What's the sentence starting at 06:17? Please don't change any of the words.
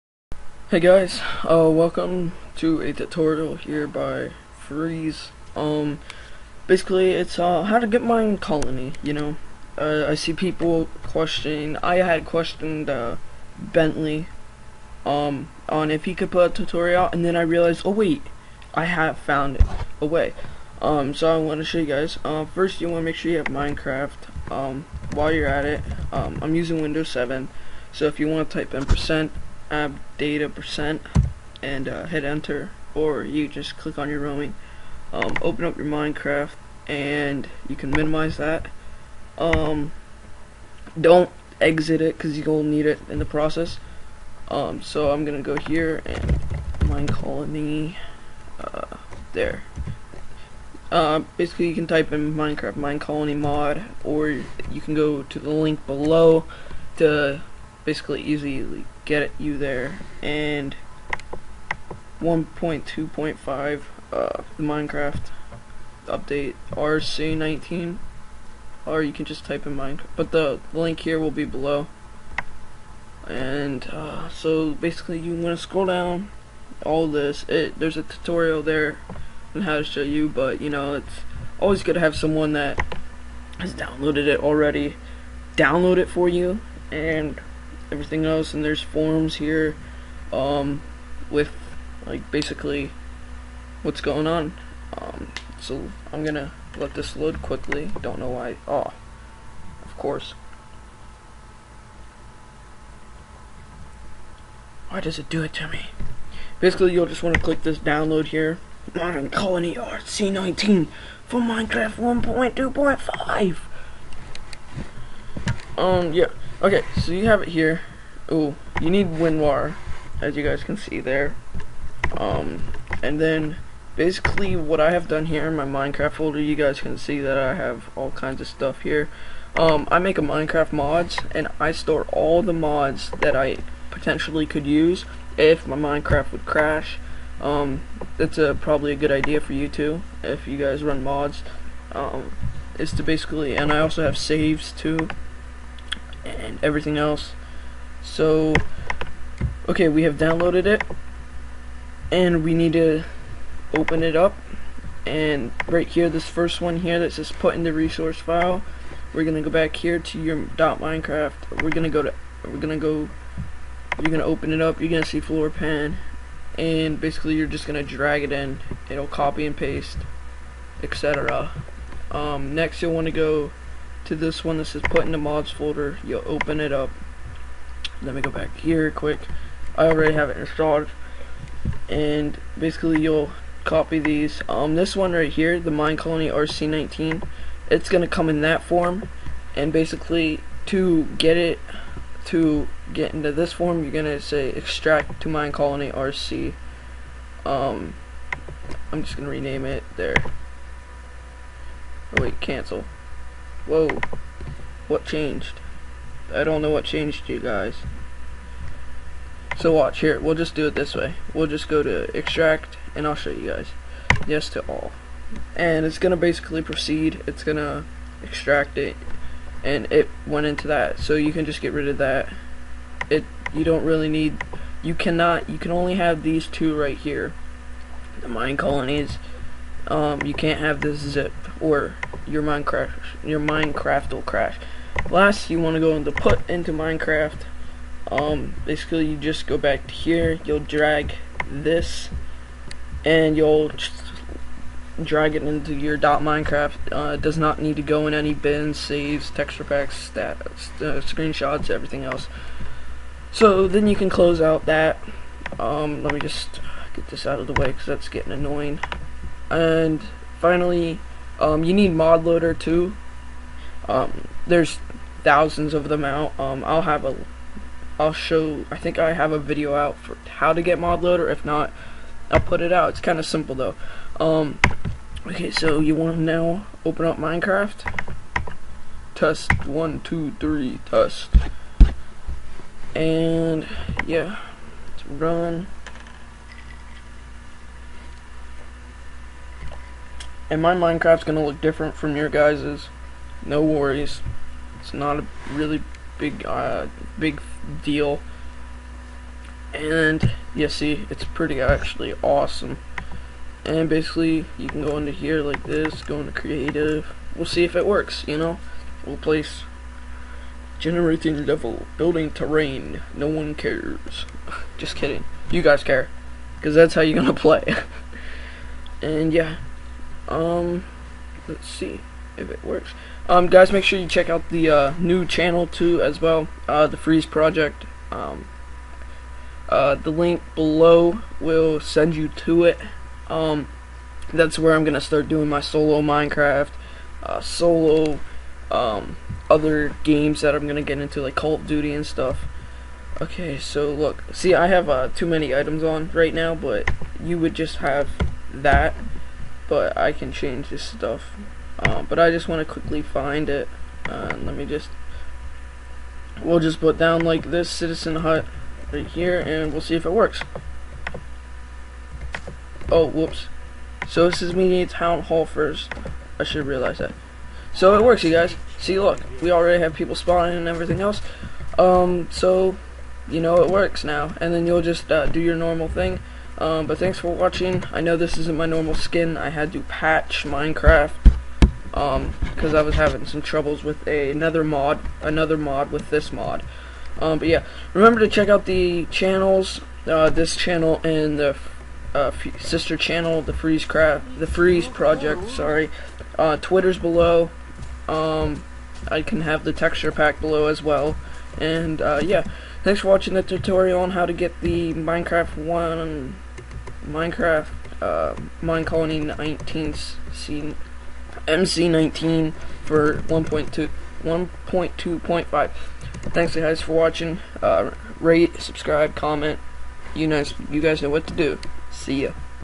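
I know this isn't my normal skin.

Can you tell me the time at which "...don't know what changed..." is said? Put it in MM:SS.
03:26.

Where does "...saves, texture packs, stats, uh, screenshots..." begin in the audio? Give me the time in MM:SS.
04:08.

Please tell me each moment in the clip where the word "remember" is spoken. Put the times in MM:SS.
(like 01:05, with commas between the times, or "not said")
06:27.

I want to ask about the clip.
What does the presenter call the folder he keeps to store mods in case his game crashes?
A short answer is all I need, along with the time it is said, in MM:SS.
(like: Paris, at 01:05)
Minecraft mods, at 02:10.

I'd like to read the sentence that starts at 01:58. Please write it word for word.
Oh, you need WinRAR, as you guys can see there.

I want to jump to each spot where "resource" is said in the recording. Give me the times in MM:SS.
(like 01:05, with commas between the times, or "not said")
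02:37.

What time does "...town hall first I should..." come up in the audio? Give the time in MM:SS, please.
06:04.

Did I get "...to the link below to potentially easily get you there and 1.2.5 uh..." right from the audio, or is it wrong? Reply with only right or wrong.
wrong.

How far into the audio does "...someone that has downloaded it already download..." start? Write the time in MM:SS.
01:22.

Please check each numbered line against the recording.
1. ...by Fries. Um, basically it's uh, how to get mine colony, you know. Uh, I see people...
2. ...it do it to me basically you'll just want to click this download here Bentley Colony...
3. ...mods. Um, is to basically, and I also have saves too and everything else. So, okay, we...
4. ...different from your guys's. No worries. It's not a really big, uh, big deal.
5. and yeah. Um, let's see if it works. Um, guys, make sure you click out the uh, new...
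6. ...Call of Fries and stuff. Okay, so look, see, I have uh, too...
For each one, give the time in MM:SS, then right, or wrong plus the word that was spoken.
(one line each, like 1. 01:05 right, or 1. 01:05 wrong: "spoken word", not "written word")
1. 00:03 right
2. 01:45 wrong: "Modern", not "Bentley"
3. 02:21 right
4. 04:51 right
5. 05:19 wrong: "check", not "click"
6. 05:41 wrong: "Duty", not "Fries".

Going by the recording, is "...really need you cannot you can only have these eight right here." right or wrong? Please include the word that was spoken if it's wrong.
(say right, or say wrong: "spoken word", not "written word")
wrong: "two", not "eight".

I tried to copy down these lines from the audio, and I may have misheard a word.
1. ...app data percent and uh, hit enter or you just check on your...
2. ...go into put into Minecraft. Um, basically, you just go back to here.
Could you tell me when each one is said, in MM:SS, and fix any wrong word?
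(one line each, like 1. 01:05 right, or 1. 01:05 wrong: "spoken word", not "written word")
1. 00:29 wrong: "click", not "check"
2. 03:55 right.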